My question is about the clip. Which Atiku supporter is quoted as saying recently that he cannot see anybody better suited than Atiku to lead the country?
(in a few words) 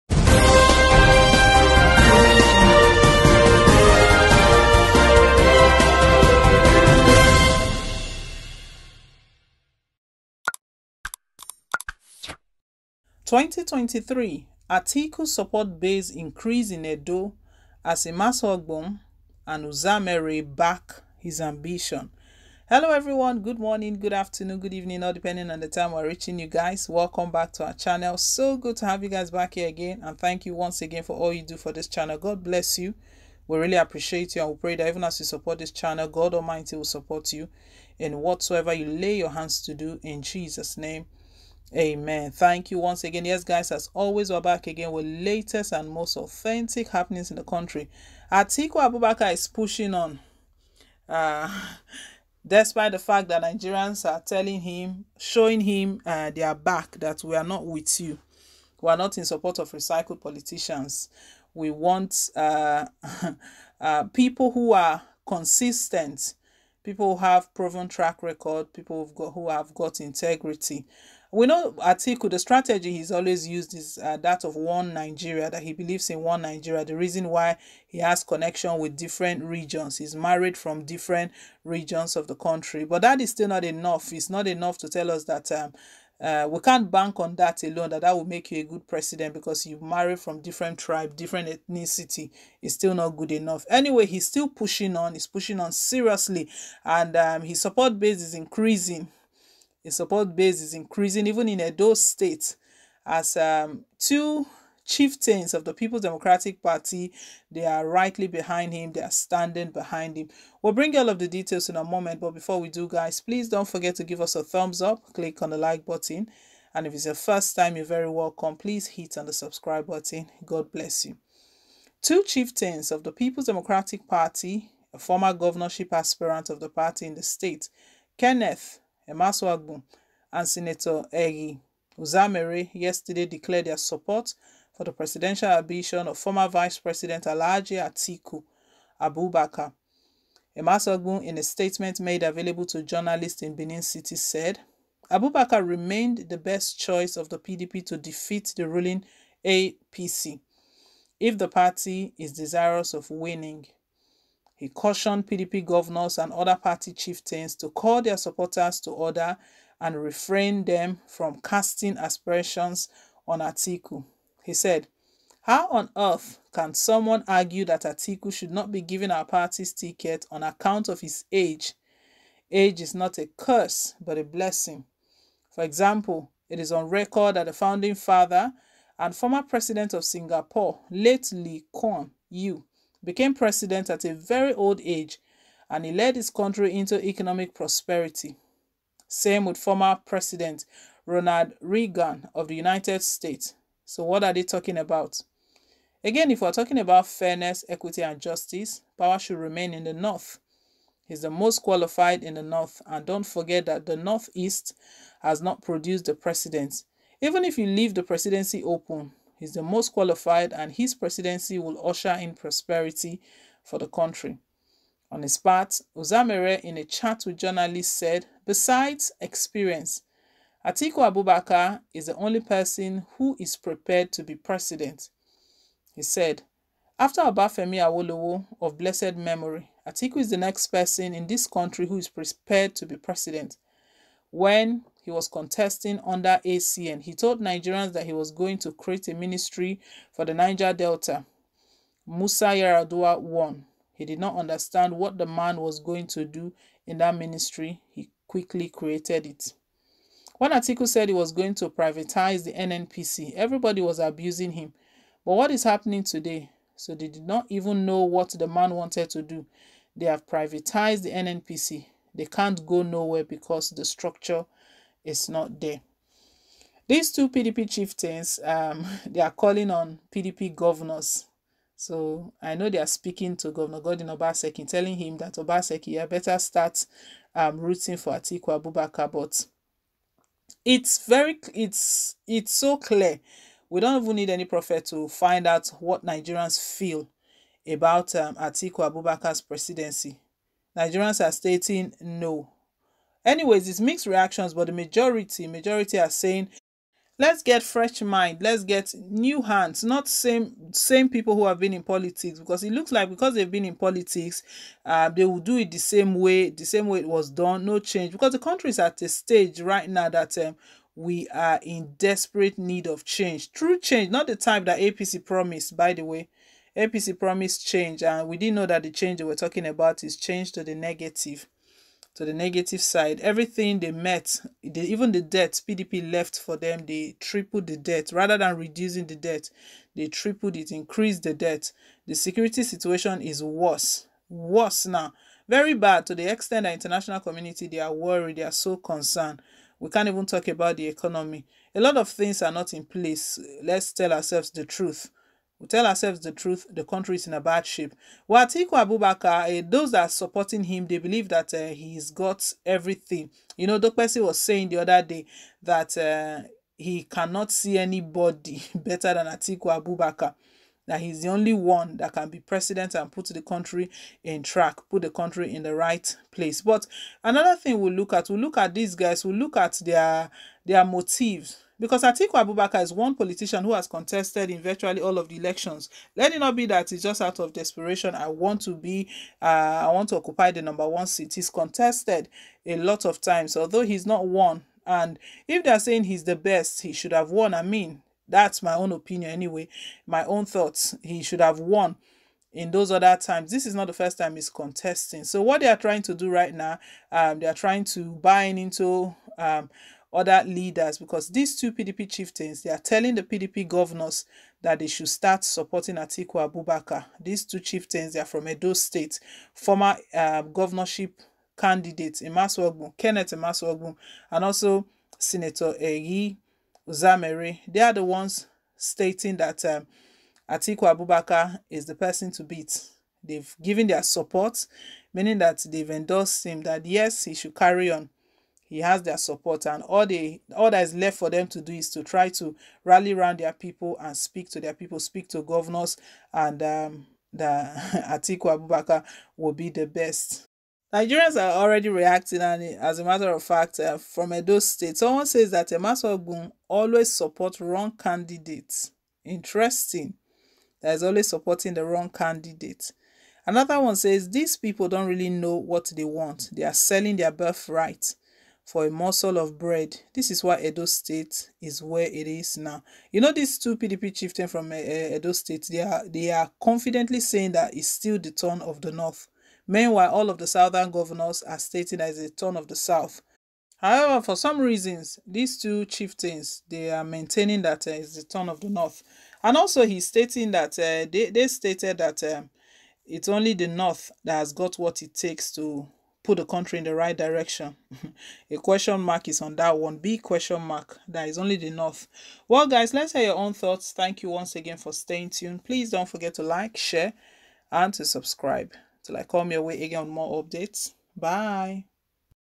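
Dokpesi.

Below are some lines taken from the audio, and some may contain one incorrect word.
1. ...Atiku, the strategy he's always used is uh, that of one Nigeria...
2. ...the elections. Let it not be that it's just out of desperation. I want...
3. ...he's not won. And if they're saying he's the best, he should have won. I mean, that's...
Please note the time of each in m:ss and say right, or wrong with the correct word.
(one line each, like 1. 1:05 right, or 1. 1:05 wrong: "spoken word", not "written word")
1. 1:11 right
2. 6:15 right
3. 6:23 right.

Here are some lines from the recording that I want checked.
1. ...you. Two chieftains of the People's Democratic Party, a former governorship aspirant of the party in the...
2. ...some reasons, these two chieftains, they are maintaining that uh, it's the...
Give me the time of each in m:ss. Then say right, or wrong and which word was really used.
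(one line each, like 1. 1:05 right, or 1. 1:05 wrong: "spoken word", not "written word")
1. 2:01 right
2. 7:54 right.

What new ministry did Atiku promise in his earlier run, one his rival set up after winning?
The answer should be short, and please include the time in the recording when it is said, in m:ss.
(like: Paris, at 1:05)
Ministry for the Niger Delta, at 3:59.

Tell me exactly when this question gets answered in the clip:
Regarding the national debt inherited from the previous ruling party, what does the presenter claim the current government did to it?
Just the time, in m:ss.
5:27.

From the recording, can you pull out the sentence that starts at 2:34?
He cautioned PDP governors and other party chieftains to call their supporters to order and refrain them from casting aspersions on Atiku.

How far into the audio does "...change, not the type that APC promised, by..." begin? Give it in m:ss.
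5:13.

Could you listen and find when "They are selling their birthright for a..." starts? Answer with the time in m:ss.
7:36.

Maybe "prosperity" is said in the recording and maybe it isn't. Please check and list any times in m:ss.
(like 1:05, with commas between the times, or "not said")
3:07, 3:32.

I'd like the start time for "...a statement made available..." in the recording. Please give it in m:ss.
2:21.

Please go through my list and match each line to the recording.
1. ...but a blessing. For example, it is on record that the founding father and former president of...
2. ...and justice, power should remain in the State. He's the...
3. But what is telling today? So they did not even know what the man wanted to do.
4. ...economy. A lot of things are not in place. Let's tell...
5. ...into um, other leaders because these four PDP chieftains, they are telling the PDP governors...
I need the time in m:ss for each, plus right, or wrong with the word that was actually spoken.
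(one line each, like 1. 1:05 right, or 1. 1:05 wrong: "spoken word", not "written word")
1. 2:53 right
2. 3:18 wrong: "North", not "State"
3. 4:15 wrong: "happening", not "telling"
4. 5:40 right
5. 6:38 wrong: "two", not "four".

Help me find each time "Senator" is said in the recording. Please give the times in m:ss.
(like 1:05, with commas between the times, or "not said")
2:10, 6:55.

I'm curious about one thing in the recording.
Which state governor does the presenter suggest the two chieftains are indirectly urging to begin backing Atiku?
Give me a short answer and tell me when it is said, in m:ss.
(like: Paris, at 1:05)
Godwin Obaseki, at 4:33.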